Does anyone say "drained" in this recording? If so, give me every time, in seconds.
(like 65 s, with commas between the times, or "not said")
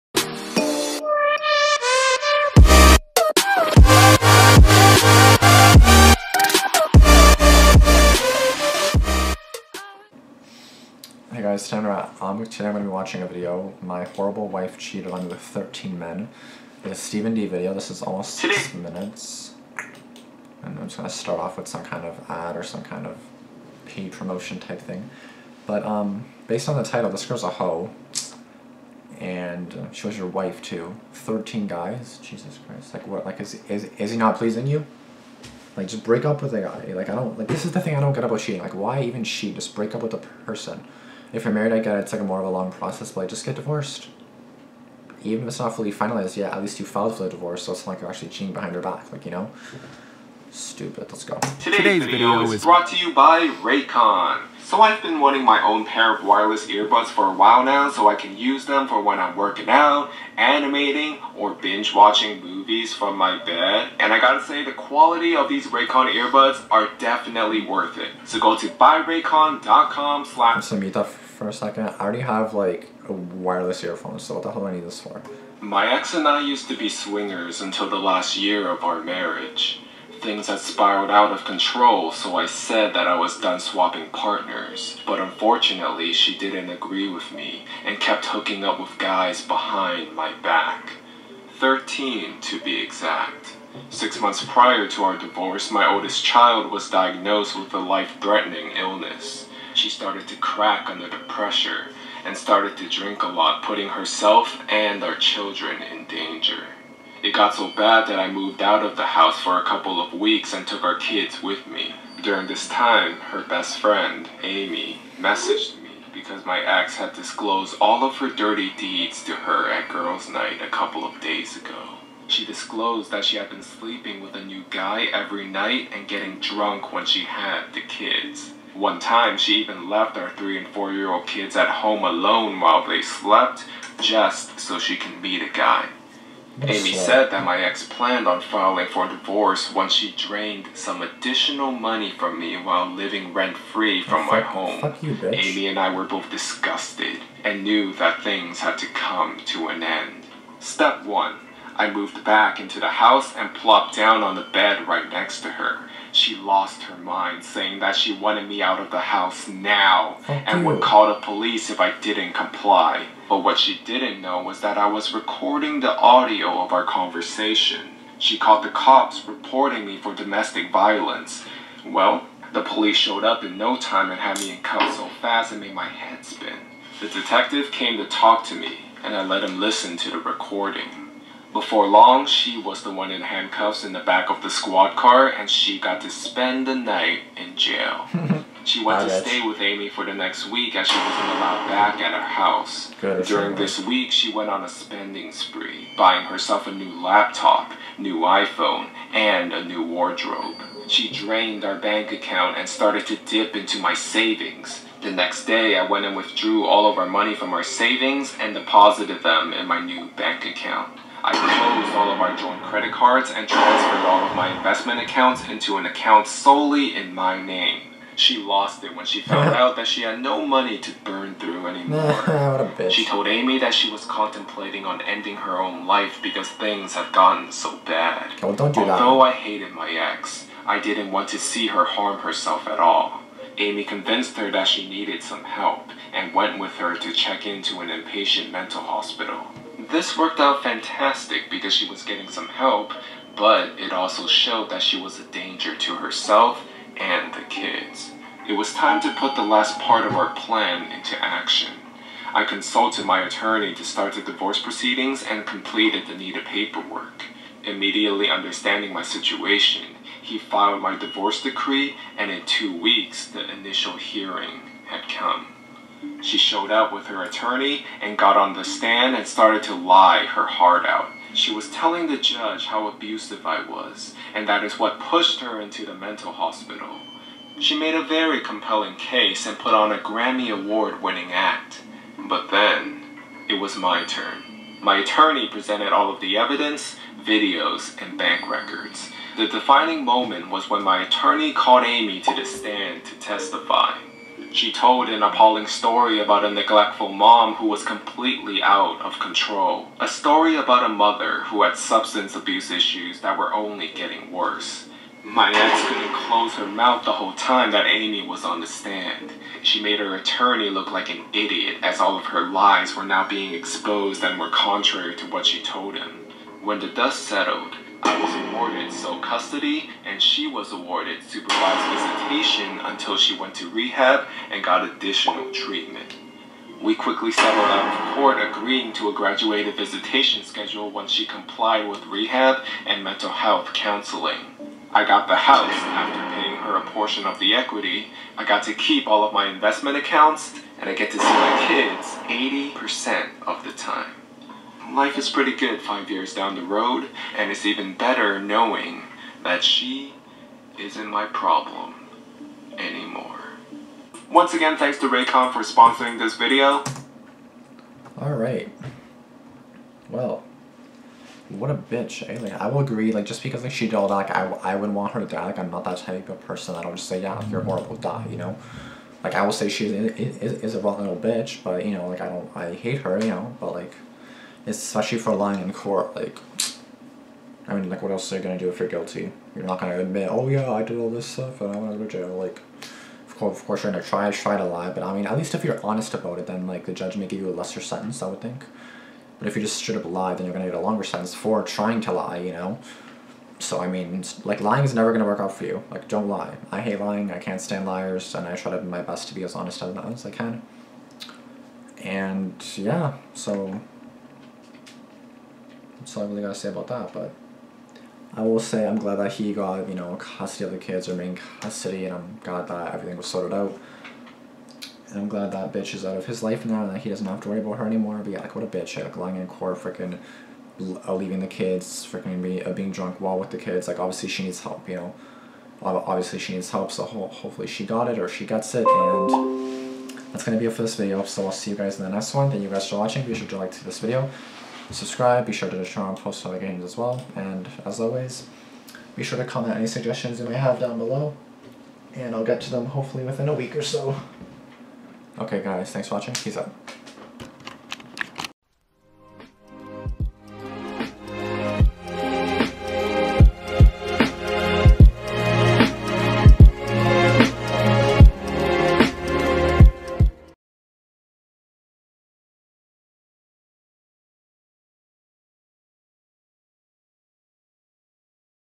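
140 s, 201 s.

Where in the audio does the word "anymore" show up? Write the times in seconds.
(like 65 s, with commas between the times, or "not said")
221 s, 352 s, 417 s.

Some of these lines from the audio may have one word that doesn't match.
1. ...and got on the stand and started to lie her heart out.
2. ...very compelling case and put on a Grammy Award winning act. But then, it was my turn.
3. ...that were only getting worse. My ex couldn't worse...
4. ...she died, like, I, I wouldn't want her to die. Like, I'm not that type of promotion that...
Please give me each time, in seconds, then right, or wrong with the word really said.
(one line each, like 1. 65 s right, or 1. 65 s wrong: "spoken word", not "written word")
1. 268 s right
2. 278 s right
3. 303 s wrong: "close", not "worse"
4. 363 s wrong: "person", not "promotion".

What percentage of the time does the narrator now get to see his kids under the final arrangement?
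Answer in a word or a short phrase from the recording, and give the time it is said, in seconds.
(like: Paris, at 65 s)
80%, at 342 s.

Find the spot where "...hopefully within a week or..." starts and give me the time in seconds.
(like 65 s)
442 s.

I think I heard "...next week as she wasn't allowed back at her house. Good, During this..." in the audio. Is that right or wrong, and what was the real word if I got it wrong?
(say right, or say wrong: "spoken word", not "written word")
right.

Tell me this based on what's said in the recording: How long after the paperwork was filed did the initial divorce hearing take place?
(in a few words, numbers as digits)
Two weeks.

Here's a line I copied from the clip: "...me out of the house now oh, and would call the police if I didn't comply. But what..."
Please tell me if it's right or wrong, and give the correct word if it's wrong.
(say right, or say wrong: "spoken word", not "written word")
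right.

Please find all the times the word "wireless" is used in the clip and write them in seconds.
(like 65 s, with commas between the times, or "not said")
56 s, 73 s.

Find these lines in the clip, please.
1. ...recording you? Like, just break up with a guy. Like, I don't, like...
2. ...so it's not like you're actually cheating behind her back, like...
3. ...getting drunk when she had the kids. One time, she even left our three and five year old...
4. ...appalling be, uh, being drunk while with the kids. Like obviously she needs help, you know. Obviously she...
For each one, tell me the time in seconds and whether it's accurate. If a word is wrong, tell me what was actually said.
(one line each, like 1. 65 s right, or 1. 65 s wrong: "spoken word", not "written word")
1. 34 s wrong: "pleasing", not "recording"
2. 47 s right
3. 126 s wrong: "four", not "five"
4. 422 s wrong: "freaking", not "appalling".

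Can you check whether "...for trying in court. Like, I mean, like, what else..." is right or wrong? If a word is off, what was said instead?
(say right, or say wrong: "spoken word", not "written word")
wrong: "lying", not "trying".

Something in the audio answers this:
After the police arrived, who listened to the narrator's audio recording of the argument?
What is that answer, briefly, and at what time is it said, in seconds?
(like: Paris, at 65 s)
The detective, at 176 s.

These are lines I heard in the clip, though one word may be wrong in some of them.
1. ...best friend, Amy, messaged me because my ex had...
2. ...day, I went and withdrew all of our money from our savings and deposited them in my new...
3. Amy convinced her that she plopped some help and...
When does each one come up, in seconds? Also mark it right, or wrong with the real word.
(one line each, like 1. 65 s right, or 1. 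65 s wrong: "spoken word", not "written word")
1. 113 s right
2. 205 s right
3. 233 s wrong: "needed", not "plopped".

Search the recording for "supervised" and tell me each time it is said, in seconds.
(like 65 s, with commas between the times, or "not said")
321 s.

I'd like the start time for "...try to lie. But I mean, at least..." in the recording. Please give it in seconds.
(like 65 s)
384 s.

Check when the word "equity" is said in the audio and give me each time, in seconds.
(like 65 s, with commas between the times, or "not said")
337 s.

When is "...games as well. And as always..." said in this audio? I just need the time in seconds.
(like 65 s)
436 s.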